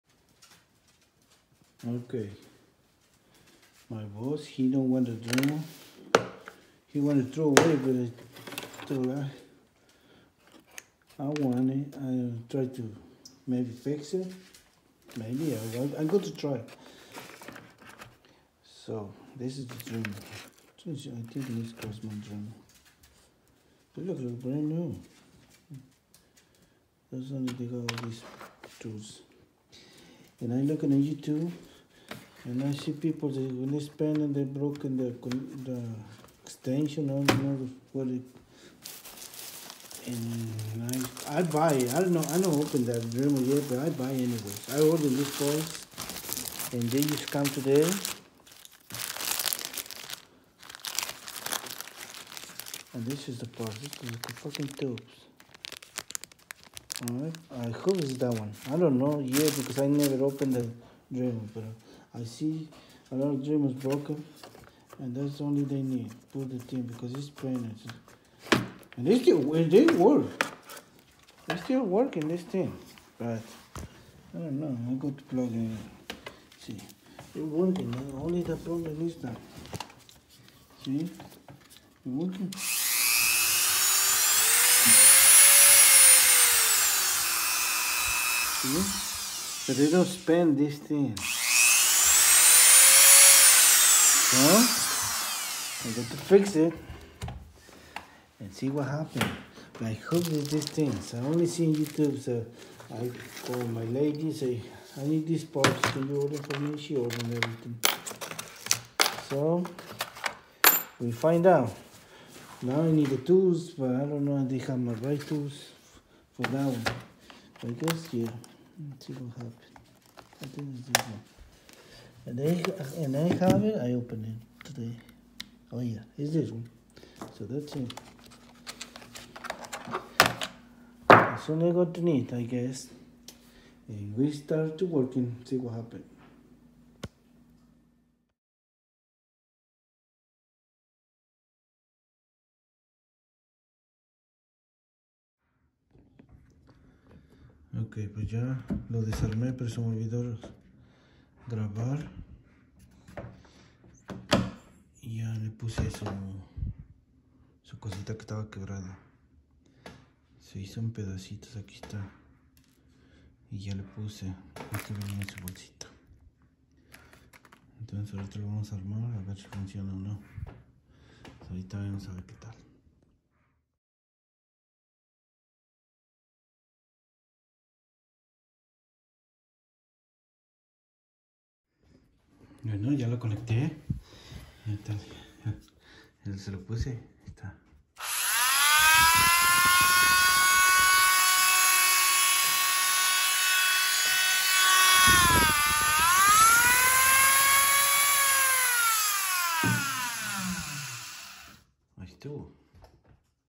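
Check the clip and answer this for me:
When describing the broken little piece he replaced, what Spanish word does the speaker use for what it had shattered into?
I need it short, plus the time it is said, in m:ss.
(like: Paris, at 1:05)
pedacitos, at 2:40.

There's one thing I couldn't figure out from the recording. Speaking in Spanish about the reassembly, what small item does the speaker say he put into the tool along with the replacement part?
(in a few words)
bolsita.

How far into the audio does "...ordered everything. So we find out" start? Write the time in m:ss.
1:46.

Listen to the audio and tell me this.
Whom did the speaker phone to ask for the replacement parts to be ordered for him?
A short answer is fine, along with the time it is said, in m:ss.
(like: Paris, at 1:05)
my lady, at 1:43.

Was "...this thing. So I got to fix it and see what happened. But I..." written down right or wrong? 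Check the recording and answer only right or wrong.
right.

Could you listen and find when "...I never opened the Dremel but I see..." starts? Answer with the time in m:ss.
0:59.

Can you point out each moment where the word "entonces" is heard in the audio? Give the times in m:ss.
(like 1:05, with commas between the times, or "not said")
2:47, 3:04.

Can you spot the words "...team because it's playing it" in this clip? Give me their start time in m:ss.
1:06.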